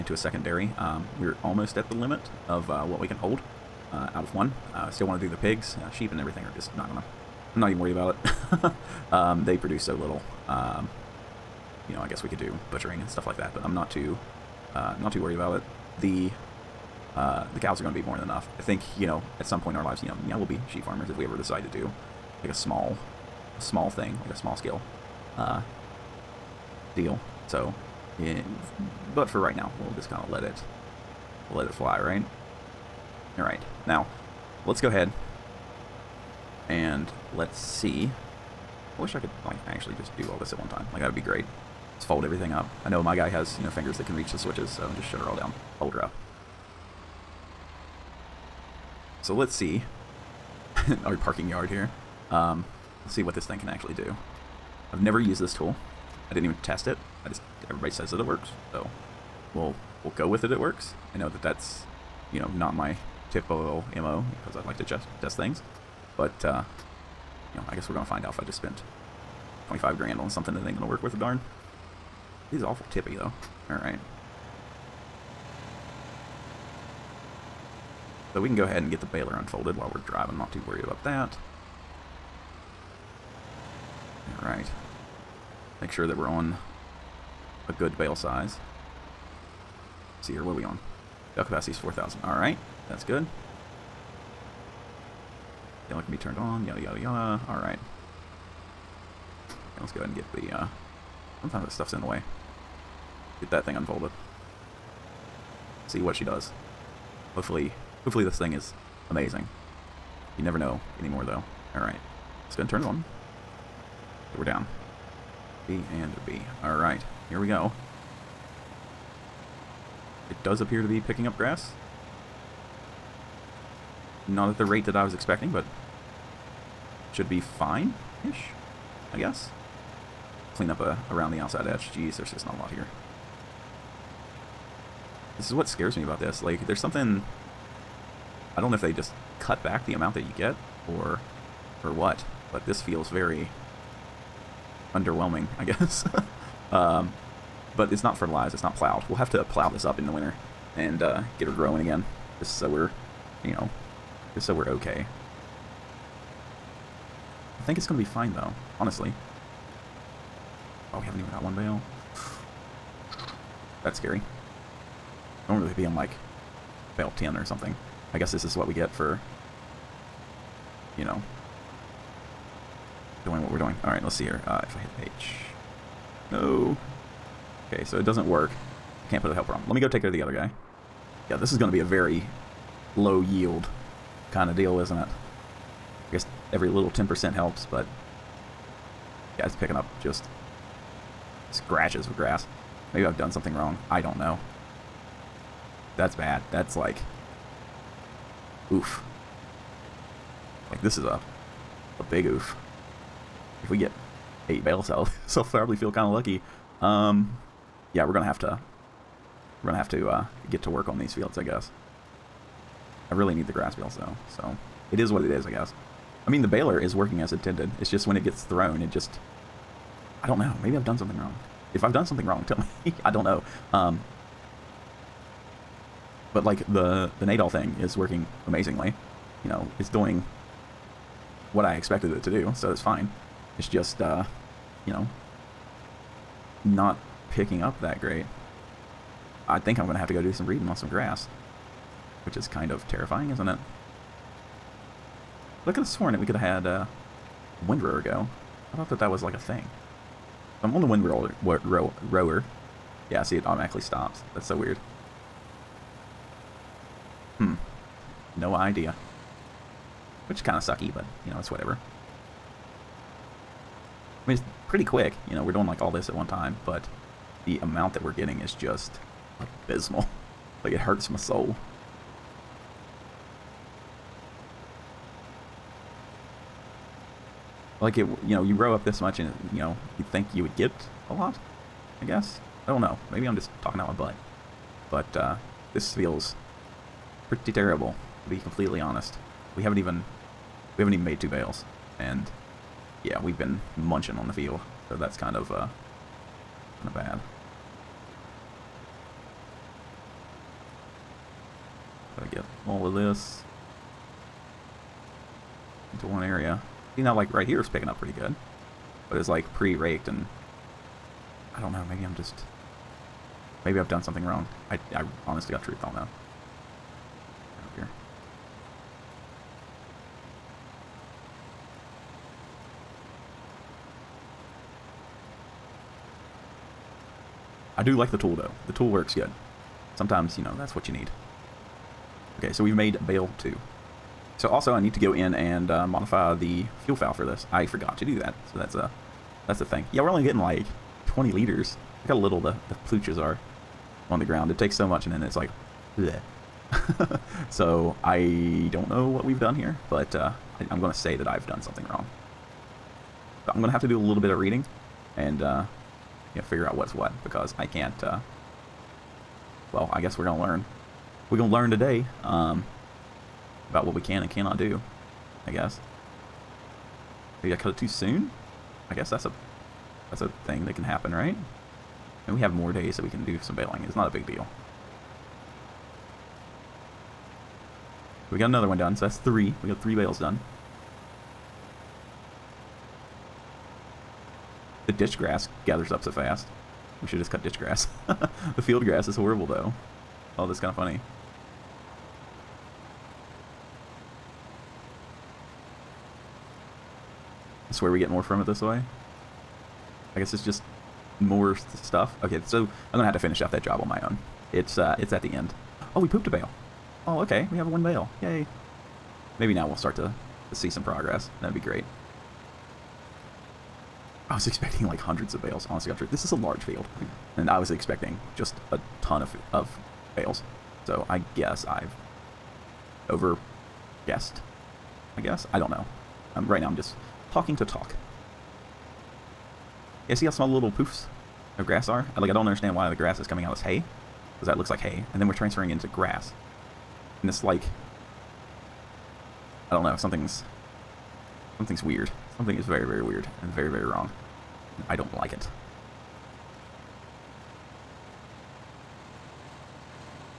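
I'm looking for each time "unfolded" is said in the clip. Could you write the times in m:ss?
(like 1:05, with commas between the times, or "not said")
1:19, 1:43.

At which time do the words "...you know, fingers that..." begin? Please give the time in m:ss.
0:43.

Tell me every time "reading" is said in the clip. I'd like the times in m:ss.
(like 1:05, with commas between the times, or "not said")
4:00, 5:54.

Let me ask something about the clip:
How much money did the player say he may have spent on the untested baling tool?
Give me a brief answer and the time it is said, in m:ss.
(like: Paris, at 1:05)
25 grand, at 1:09.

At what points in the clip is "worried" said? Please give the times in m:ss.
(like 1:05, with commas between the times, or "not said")
0:07, 0:15, 1:20.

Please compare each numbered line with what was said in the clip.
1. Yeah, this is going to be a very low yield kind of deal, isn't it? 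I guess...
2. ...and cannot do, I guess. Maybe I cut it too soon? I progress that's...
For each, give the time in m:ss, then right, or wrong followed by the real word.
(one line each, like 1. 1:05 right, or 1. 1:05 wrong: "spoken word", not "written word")
1. 3:01 right
2. 6:04 wrong: "guess", not "progress".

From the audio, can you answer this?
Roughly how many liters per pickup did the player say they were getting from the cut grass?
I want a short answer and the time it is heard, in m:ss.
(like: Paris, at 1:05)
20 liters, at 5:41.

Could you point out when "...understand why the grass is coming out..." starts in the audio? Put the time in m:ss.
7:12.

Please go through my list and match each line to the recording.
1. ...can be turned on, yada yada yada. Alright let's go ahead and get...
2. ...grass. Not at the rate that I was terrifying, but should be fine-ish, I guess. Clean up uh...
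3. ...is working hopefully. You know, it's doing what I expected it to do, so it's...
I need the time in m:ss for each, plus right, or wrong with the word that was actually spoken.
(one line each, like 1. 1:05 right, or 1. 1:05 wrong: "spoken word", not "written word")
1. 1:36 right
2. 2:01 wrong: "expecting", not "terrifying"
3. 3:47 wrong: "amazingly", not "hopefully".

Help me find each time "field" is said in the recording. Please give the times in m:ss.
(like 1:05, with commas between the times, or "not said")
3:31, 4:54, 6:28, 6:56.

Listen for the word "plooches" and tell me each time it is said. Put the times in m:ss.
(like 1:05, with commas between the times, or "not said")
5:42.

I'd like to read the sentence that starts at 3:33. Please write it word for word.
I really need the grass bales though, so it is what it is, I guess.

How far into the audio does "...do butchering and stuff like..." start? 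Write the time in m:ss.
0:12.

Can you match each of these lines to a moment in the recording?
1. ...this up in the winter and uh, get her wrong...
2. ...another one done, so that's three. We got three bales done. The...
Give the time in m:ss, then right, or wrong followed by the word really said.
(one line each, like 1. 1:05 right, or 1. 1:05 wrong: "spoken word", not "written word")
1. 2:29 wrong: "growing", not "wrong"
2. 6:18 right.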